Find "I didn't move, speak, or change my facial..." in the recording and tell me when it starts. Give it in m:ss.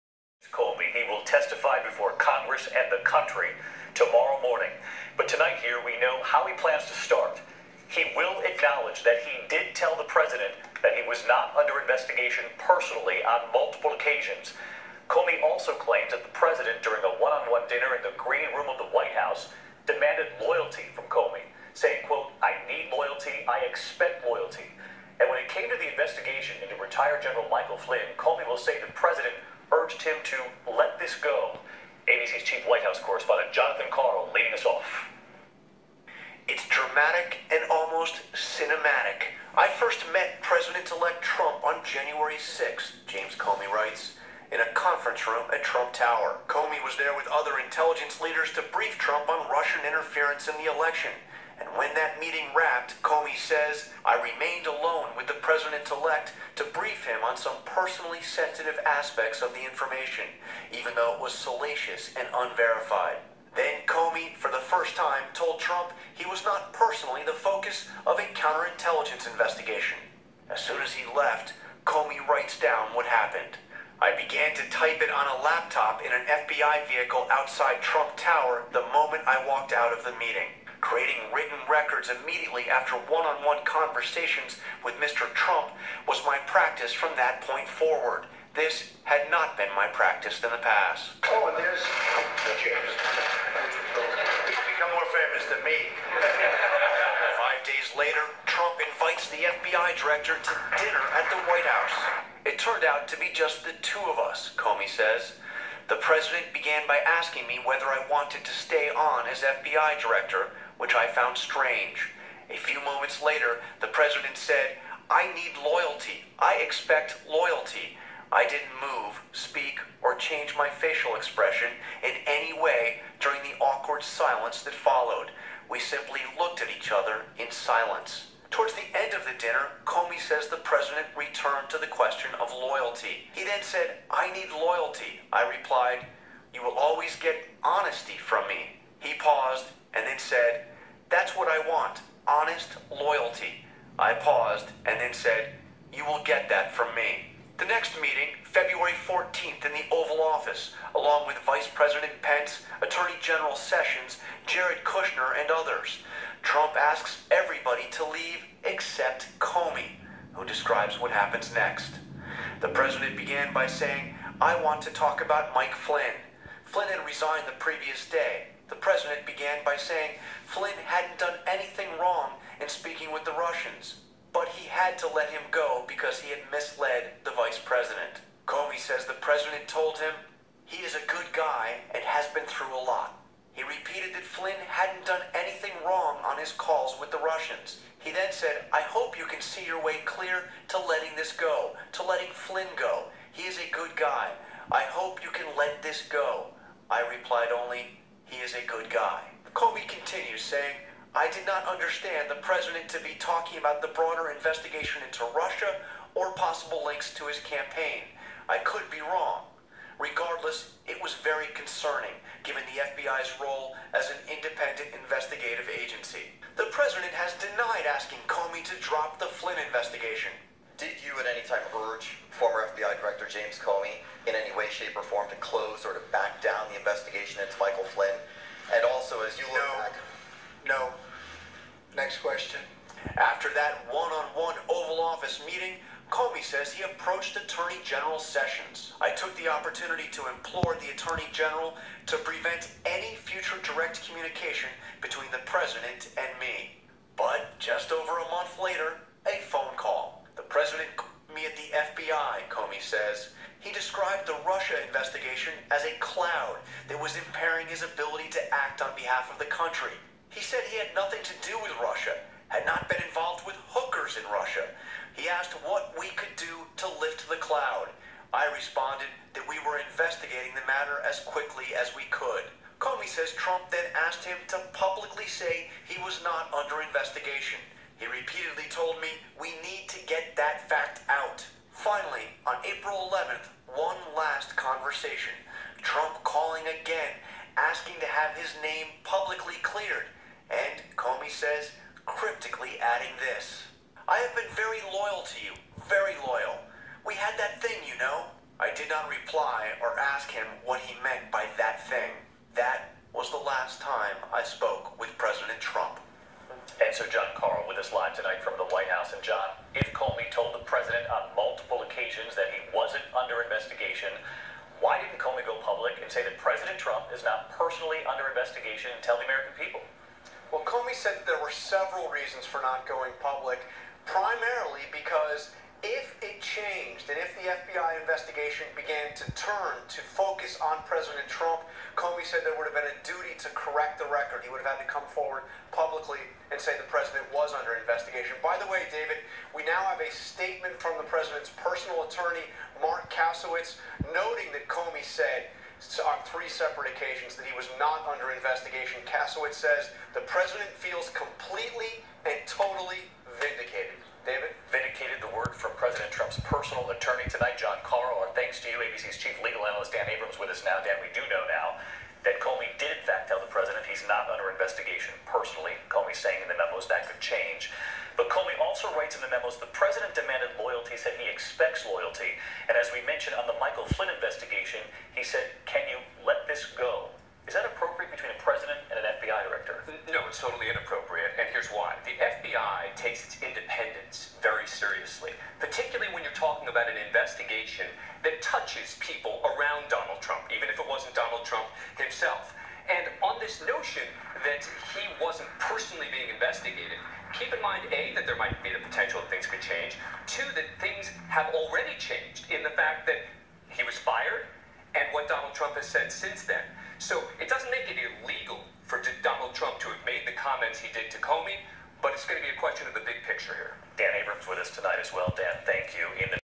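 1:58.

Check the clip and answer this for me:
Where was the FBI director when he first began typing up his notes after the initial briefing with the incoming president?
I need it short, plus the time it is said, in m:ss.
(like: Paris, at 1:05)
FBI vehicle, at 1:16.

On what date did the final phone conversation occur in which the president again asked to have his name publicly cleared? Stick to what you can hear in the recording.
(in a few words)
April 11th.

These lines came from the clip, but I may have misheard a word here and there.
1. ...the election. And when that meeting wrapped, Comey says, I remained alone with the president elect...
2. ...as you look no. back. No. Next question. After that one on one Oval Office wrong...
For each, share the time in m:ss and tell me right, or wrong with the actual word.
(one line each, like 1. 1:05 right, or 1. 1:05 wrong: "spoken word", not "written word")
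1. 0:50 right
2. 3:49 wrong: "meeting", not "wrong".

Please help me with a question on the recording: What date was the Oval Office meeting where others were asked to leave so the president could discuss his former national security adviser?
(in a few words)
February 14th.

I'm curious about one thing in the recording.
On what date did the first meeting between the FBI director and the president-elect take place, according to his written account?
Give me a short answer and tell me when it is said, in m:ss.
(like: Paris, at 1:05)
January 6th, at 0:41.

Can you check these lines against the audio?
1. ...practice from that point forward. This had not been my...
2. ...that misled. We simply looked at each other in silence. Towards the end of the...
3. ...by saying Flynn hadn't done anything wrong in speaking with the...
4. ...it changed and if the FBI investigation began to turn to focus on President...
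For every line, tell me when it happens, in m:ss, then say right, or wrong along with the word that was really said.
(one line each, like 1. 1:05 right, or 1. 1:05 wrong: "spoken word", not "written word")
1. 1:26 right
2. 2:04 wrong: "followed", not "misled"
3. 2:49 right
4. 5:26 right.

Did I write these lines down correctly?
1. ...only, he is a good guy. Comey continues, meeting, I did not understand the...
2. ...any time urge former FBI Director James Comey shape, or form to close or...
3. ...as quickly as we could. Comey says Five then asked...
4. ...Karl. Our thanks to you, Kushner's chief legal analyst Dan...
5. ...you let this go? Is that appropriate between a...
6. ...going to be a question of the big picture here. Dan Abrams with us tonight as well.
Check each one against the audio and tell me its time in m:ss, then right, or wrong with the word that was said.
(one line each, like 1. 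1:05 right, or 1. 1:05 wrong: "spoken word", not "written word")
1. 3:17 wrong: "saying", not "meeting"
2. 3:41 right
3. 4:31 wrong: "Trump", not "Five"
4. 5:57 wrong: "ABC", not "Kushner"
5. 6:15 right
6. 6:52 right.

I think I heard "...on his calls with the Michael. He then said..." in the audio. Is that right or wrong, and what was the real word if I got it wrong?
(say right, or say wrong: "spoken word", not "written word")
wrong: "Russians", not "Michael".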